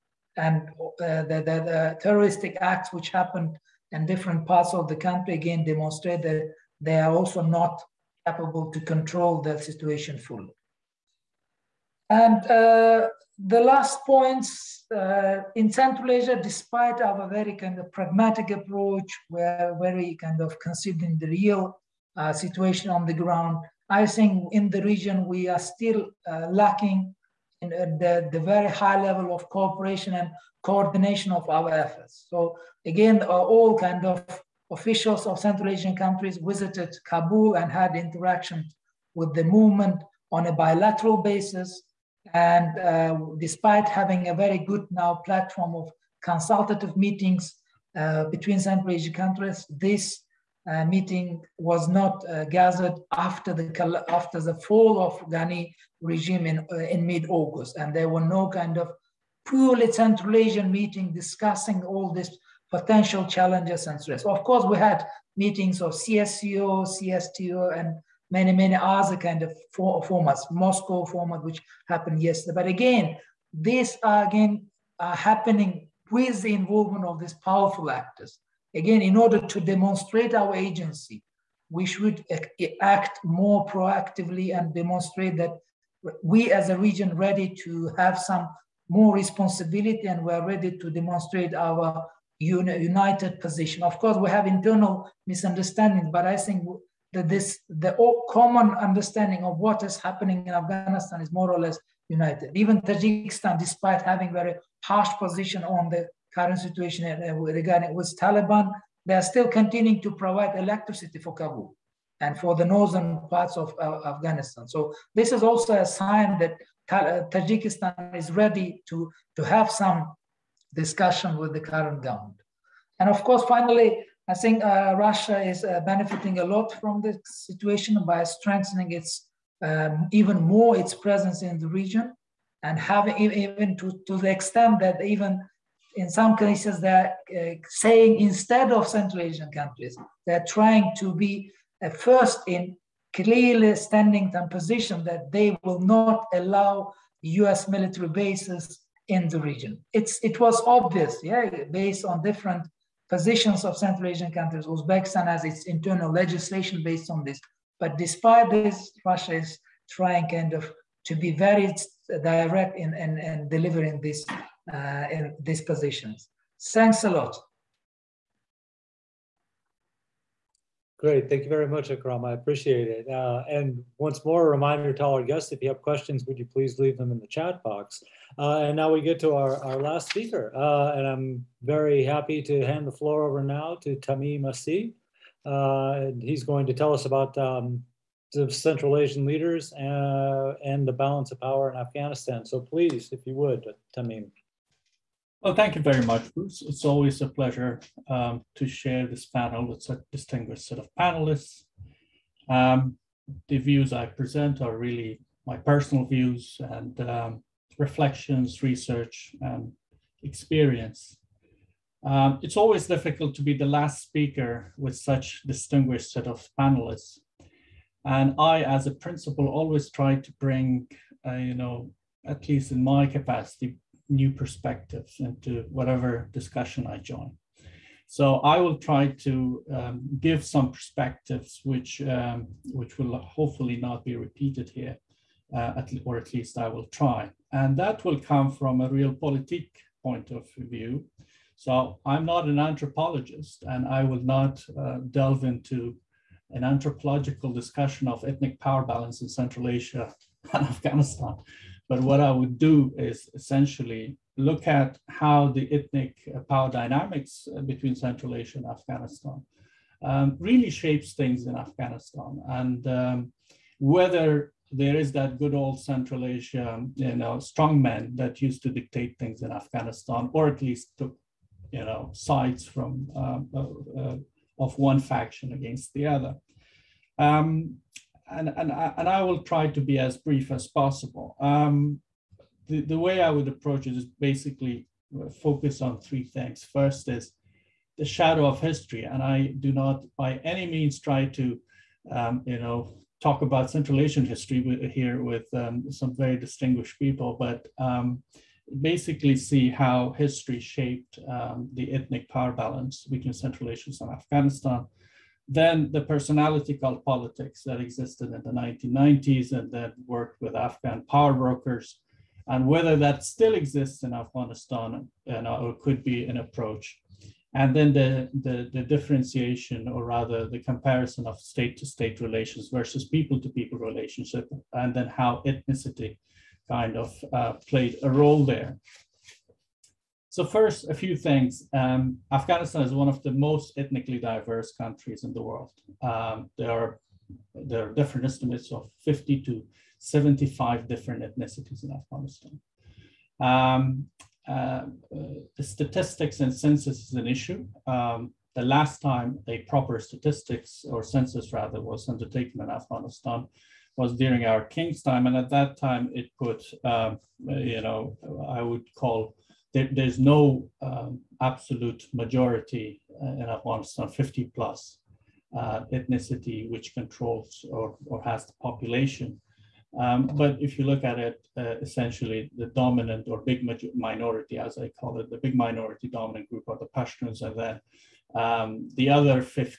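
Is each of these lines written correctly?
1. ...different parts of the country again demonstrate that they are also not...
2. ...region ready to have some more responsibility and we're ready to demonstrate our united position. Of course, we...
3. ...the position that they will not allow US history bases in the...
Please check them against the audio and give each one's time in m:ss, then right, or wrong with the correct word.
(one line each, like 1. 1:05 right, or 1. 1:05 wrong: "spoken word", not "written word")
1. 0:04 right
2. 1:26 right
3. 2:24 wrong: "military", not "history".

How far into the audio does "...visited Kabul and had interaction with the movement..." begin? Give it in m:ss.
0:36.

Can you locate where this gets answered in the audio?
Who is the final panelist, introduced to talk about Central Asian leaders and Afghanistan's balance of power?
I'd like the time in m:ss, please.
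3:03.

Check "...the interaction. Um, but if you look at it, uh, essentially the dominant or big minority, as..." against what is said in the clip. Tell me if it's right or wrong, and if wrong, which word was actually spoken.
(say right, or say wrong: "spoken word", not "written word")
wrong: "population", not "interaction".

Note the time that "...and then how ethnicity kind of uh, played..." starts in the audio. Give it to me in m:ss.
5:24.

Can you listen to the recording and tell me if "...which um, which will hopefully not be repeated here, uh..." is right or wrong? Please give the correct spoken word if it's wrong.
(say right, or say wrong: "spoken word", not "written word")
right.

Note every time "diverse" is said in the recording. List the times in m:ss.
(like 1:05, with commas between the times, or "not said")
5:34.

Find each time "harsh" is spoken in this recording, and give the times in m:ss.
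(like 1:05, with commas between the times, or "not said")
1:44.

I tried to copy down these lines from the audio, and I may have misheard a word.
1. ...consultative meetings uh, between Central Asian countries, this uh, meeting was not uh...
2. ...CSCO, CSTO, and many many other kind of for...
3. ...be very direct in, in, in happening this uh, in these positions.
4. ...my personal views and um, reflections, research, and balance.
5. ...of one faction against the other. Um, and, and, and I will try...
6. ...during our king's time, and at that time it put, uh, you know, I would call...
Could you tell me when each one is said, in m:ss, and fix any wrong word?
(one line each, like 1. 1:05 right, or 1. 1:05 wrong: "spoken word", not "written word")
1. 0:46 right
2. 1:05 right
3. 2:41 wrong: "delivering", not "happening"
4. 3:25 wrong: "experience", not "balance"
5. 4:34 right
6. 5:54 right.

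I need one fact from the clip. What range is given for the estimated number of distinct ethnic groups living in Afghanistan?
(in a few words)
50 to 75.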